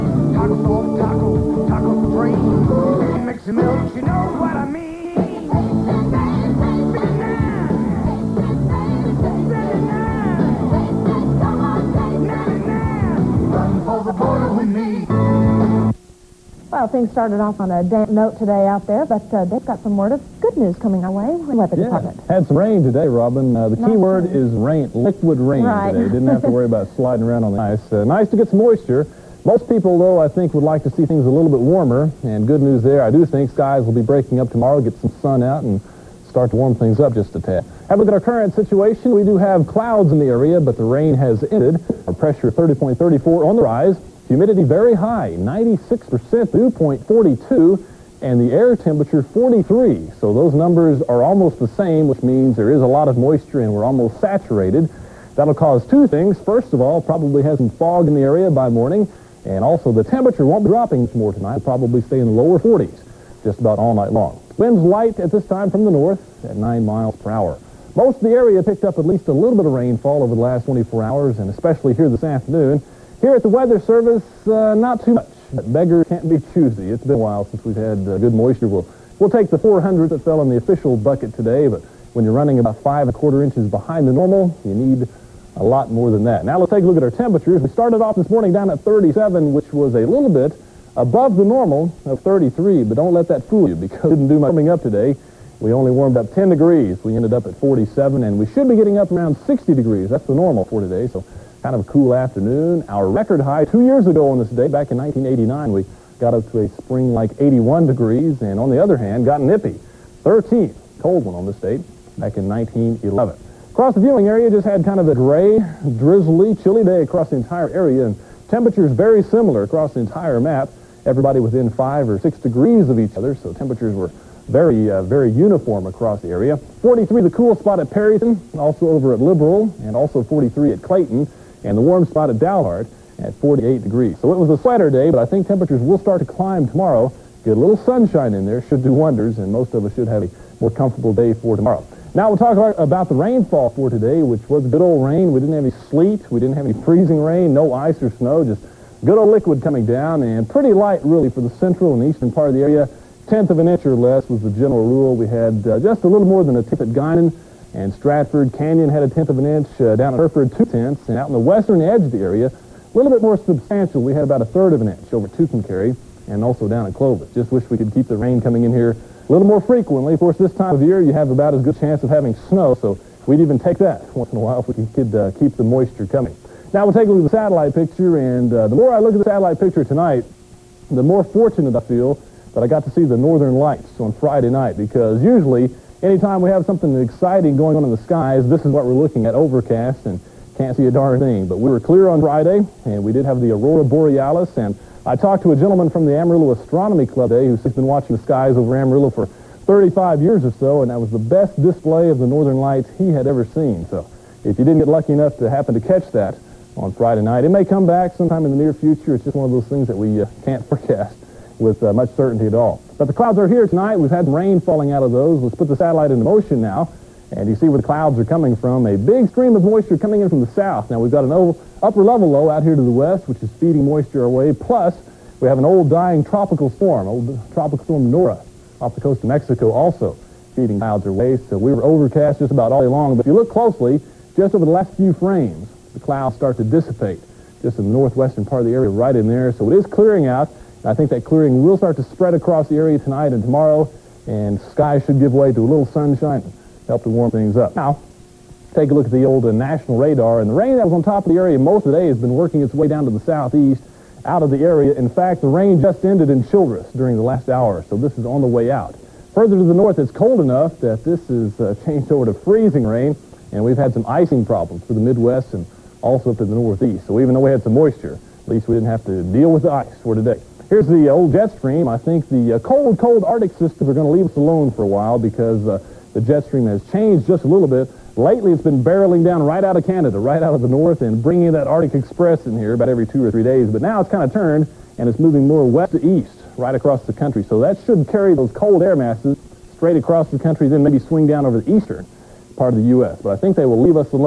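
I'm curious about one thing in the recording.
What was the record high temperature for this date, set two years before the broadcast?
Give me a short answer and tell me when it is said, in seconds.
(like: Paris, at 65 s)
81 degrees, at 107 s.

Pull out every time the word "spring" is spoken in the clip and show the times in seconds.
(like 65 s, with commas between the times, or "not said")
106 s.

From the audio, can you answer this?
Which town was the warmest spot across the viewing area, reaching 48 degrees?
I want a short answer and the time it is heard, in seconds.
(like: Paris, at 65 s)
Dalhart, at 132 s.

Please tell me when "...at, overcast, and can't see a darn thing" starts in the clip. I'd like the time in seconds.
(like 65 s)
189 s.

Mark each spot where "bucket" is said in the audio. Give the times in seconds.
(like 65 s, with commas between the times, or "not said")
80 s.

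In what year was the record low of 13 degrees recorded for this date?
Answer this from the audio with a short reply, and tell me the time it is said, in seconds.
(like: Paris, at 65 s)
1911, at 112 s.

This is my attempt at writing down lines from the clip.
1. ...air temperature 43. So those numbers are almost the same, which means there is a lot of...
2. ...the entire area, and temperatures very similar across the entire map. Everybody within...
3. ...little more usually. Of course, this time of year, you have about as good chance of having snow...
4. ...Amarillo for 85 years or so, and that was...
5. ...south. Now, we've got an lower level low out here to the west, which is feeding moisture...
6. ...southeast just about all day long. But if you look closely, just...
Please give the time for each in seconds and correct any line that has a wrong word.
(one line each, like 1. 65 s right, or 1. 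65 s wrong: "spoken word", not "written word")
1. 48 s right
2. 117 s right
3. 169 s wrong: "frequently", not "usually"
4. 198 s wrong: "35", not "85"
5. 220 s wrong: "upper", not "lower"
6. 231 s wrong: "overcast", not "southeast".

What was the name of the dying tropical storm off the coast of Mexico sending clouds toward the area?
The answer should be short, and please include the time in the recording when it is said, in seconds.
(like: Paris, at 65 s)
Nora, at 228 s.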